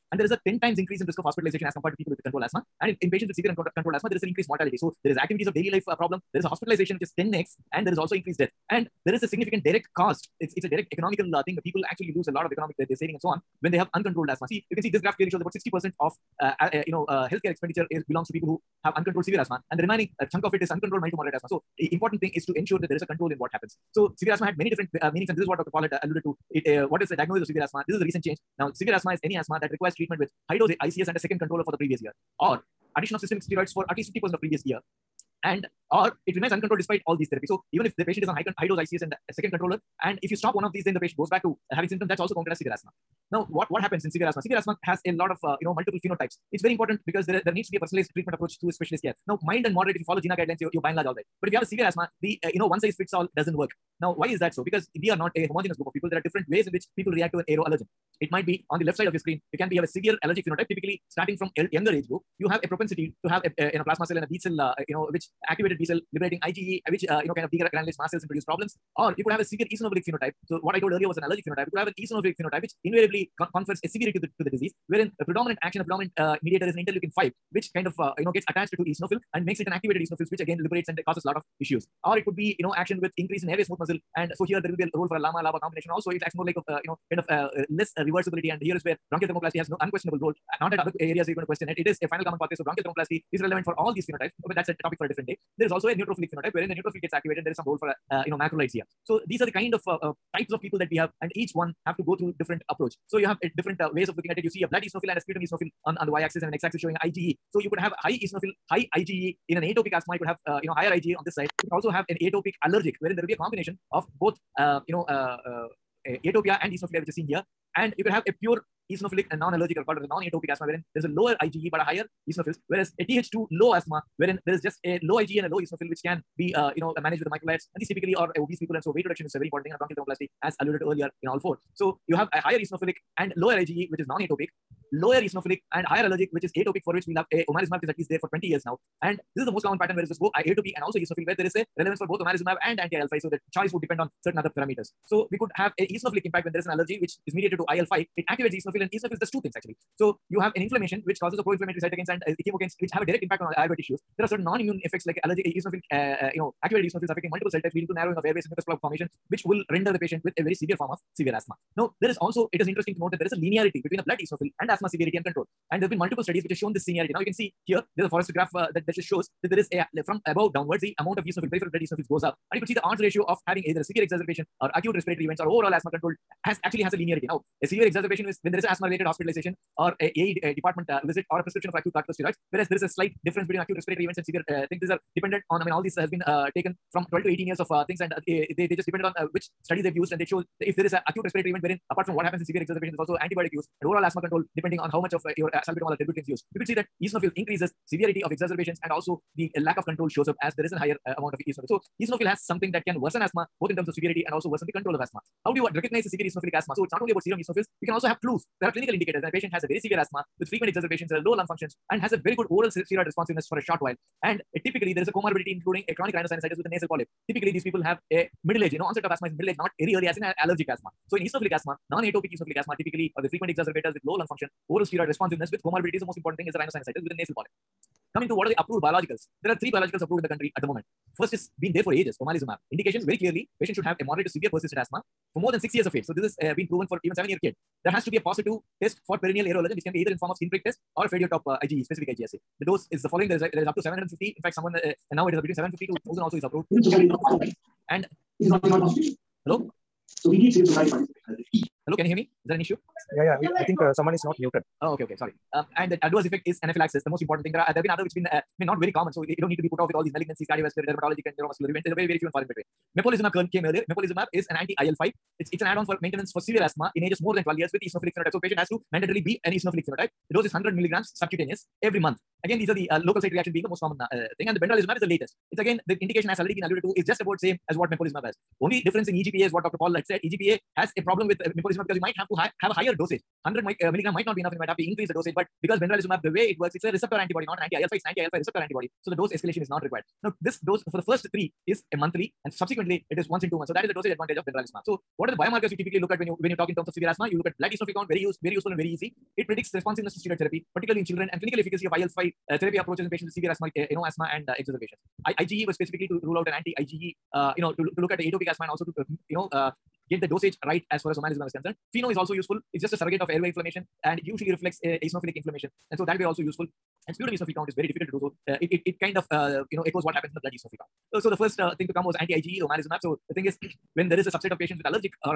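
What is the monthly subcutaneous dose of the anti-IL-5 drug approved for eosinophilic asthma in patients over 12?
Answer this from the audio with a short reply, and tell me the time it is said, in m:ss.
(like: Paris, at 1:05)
100 milligrams, at 4:30.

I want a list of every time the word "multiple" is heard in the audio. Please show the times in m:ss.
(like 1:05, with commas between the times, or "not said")
0:45, 2:37, 2:45.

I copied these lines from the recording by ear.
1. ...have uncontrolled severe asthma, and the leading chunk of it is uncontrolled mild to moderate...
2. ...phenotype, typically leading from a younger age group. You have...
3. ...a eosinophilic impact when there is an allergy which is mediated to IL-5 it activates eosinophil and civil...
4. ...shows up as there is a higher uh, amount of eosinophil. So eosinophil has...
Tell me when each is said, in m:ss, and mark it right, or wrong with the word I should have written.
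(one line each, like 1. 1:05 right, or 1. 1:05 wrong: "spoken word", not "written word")
1. 0:18 wrong: "remaining", not "leading"
2. 1:00 wrong: "starting", not "leading"
3. 2:25 wrong: "eosinophil", not "civil"
4. 3:20 right.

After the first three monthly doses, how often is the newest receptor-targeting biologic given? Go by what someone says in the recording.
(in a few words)
once in two months.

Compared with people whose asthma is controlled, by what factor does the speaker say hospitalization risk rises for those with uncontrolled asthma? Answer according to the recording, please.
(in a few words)
10 times.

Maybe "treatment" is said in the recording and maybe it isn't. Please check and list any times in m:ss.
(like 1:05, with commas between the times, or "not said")
0:29, 0:48.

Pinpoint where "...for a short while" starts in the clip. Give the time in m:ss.
3:33.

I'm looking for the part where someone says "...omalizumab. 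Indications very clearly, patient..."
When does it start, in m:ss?
3:52.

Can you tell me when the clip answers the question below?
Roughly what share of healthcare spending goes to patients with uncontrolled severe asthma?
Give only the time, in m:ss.
0:15.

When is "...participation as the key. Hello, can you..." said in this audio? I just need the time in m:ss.
4:10.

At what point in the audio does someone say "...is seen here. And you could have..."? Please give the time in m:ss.
1:57.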